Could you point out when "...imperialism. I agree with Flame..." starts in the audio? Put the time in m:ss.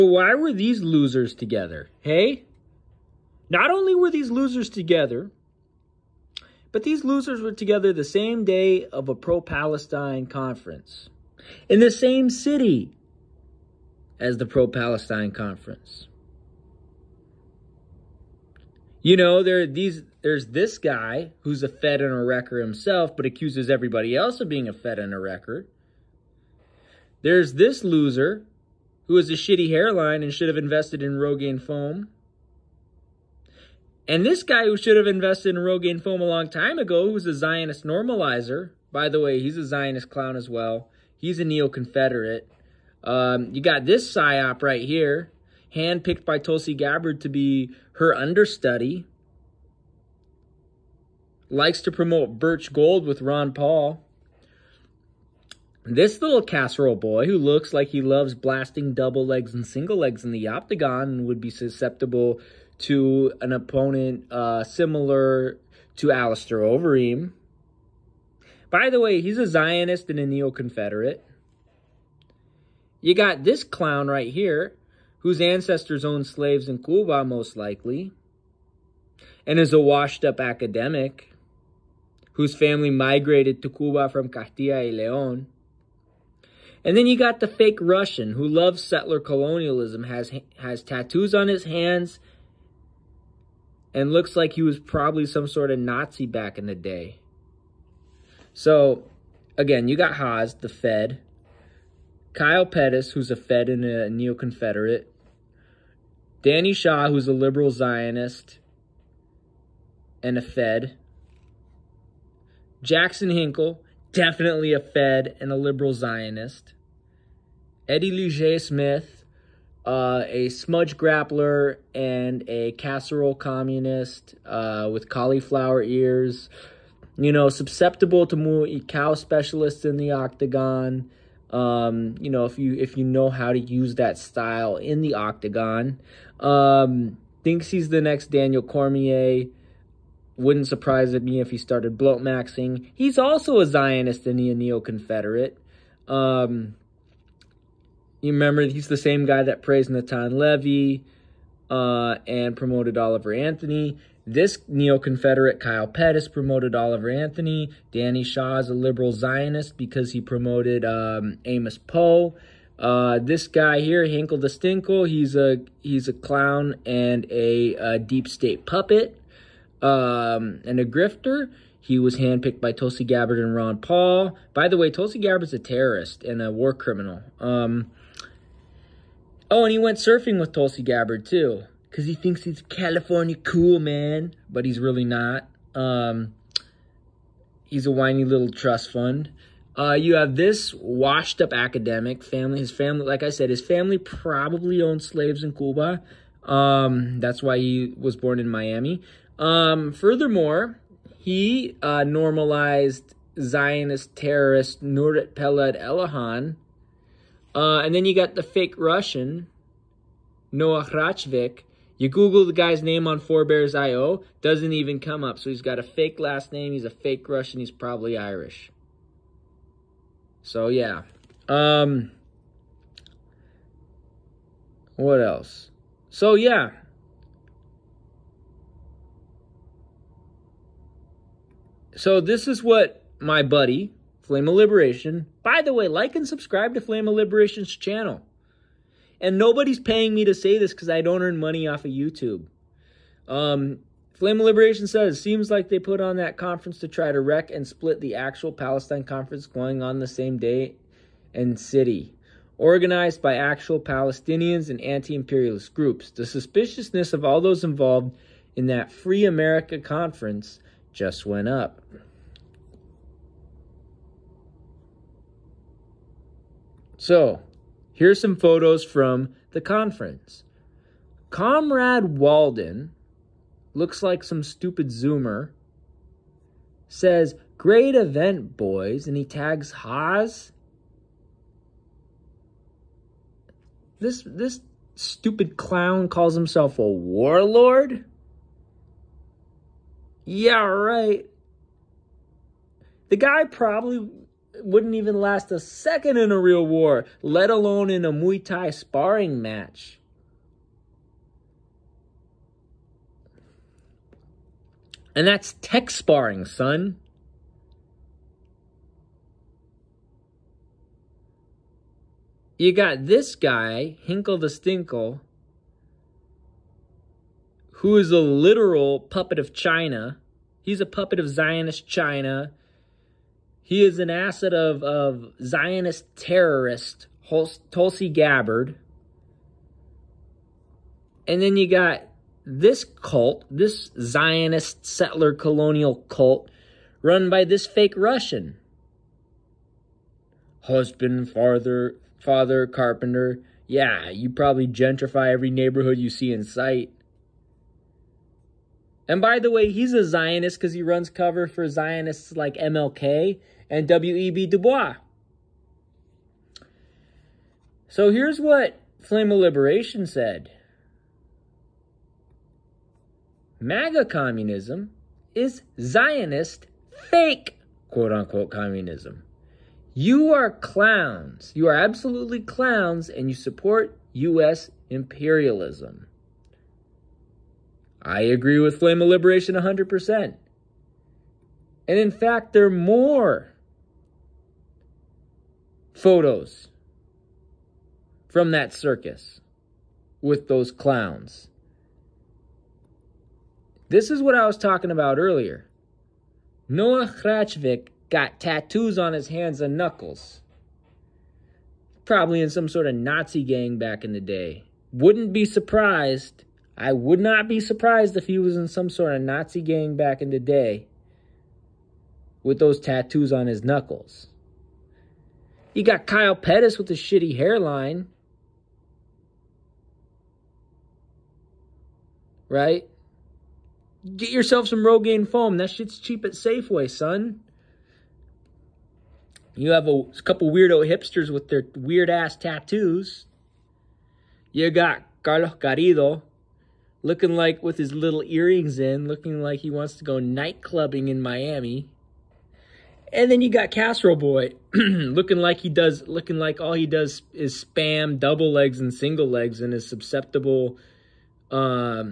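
6:14.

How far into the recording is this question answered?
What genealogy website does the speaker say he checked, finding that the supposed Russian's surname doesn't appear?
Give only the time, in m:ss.
3:33.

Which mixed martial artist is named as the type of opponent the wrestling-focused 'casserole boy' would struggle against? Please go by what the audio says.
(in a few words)
Alistair Overeem.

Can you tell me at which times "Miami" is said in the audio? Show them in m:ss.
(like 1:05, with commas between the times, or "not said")
3:18, 7:21.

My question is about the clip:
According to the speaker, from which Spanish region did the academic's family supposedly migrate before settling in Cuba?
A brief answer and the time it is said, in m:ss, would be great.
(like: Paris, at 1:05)
Castilla y León, at 1:24.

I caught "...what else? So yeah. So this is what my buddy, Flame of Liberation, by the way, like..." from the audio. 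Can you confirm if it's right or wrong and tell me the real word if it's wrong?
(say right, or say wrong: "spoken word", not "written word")
right.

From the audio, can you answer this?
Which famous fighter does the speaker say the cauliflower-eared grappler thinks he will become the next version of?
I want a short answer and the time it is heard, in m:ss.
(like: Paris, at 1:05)
Daniel Cormier, at 2:18.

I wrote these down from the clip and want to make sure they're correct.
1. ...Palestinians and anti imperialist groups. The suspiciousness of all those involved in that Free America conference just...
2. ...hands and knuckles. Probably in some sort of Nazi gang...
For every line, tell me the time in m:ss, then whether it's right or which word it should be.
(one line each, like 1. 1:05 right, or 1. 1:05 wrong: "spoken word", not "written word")
1. 4:13 right
2. 6:39 right.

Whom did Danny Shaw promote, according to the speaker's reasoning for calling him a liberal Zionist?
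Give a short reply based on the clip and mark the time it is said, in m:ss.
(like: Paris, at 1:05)
Amos Poe, at 2:41.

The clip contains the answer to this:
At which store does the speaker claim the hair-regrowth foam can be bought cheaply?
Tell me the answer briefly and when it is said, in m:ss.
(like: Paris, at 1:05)
Safeway, at 7:06.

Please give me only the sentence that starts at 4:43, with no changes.
This, this stupid clown calls himself a warlord?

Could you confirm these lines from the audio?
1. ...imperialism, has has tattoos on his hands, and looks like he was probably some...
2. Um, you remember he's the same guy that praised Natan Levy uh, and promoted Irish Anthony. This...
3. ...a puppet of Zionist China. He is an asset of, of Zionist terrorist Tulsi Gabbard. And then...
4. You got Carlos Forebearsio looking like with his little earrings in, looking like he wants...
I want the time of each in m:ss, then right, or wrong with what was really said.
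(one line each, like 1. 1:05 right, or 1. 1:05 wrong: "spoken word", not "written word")
1. 1:29 wrong: "colonialism", not "imperialism"
2. 2:26 wrong: "Oliver", not "Irish"
3. 5:20 right
4. 7:14 wrong: "Garrido", not "Forebearsio".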